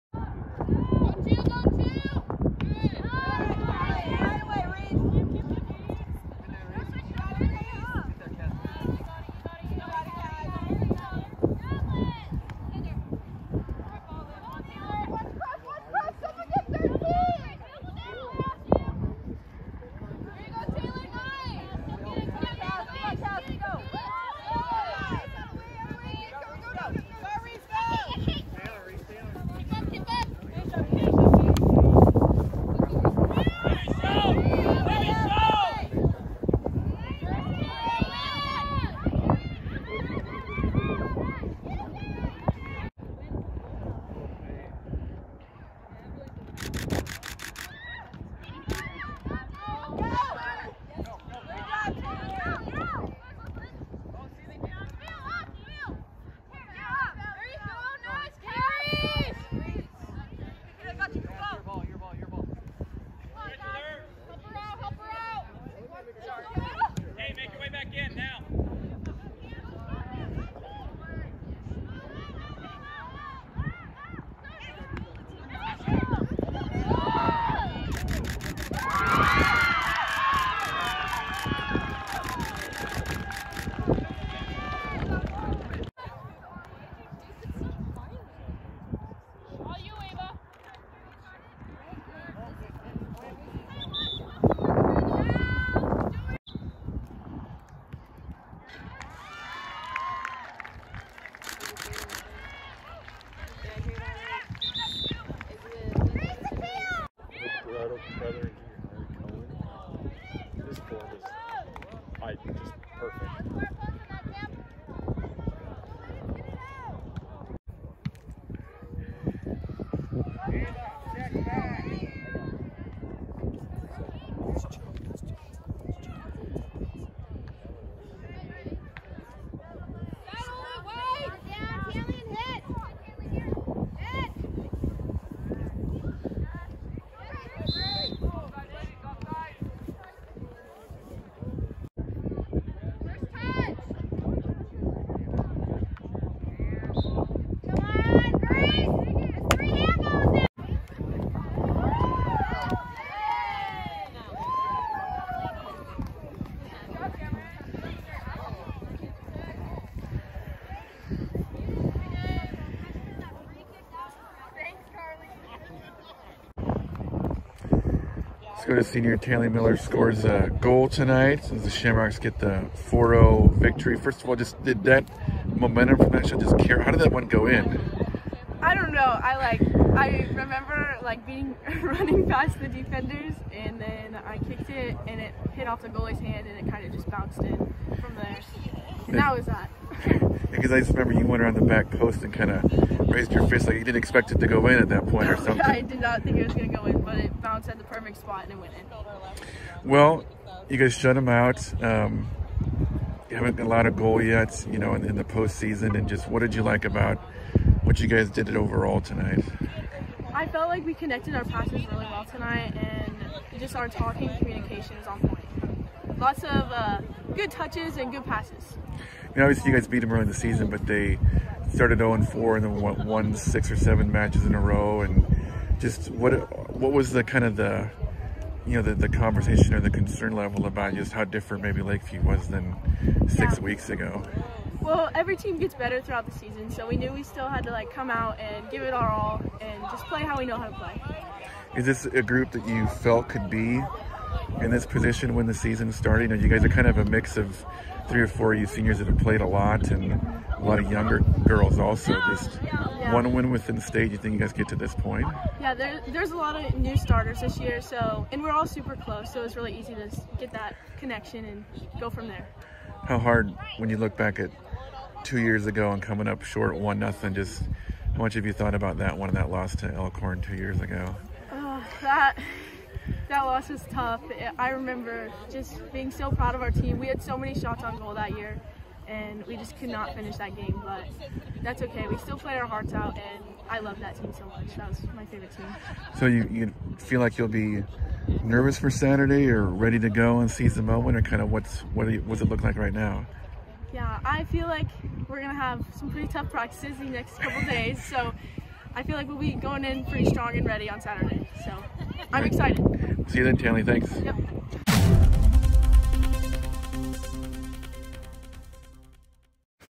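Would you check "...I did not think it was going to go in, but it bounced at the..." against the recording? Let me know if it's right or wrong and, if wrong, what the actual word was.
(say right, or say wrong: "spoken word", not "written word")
right.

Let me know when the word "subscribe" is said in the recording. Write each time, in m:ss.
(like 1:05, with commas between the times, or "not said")
not said.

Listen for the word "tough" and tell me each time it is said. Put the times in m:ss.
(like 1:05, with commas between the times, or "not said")
4:33, 4:56.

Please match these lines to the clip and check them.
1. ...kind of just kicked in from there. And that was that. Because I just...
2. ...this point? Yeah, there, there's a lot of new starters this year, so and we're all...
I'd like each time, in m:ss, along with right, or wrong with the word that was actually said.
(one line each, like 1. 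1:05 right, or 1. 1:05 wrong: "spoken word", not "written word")
1. 3:06 wrong: "bounced", not "kicked"
2. 4:14 right.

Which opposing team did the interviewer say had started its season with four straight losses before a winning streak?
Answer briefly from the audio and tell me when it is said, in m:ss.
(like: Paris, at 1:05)
Lakeview, at 3:51.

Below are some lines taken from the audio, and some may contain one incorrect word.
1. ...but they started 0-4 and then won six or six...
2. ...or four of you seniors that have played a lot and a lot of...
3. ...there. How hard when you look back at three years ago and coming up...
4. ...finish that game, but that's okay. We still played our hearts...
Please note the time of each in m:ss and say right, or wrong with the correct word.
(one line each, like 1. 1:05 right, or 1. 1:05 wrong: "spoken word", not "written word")
1. 3:40 wrong: "seven", not "six"
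2. 4:08 right
3. 4:22 wrong: "two", not "three"
4. 4:40 right.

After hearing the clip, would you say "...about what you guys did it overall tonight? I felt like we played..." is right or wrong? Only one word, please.
wrong.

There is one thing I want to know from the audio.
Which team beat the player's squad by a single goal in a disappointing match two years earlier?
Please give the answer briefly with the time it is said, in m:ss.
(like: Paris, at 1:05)
Elkhorn, at 4:29.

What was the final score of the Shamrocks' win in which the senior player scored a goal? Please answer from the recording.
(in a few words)
4-0.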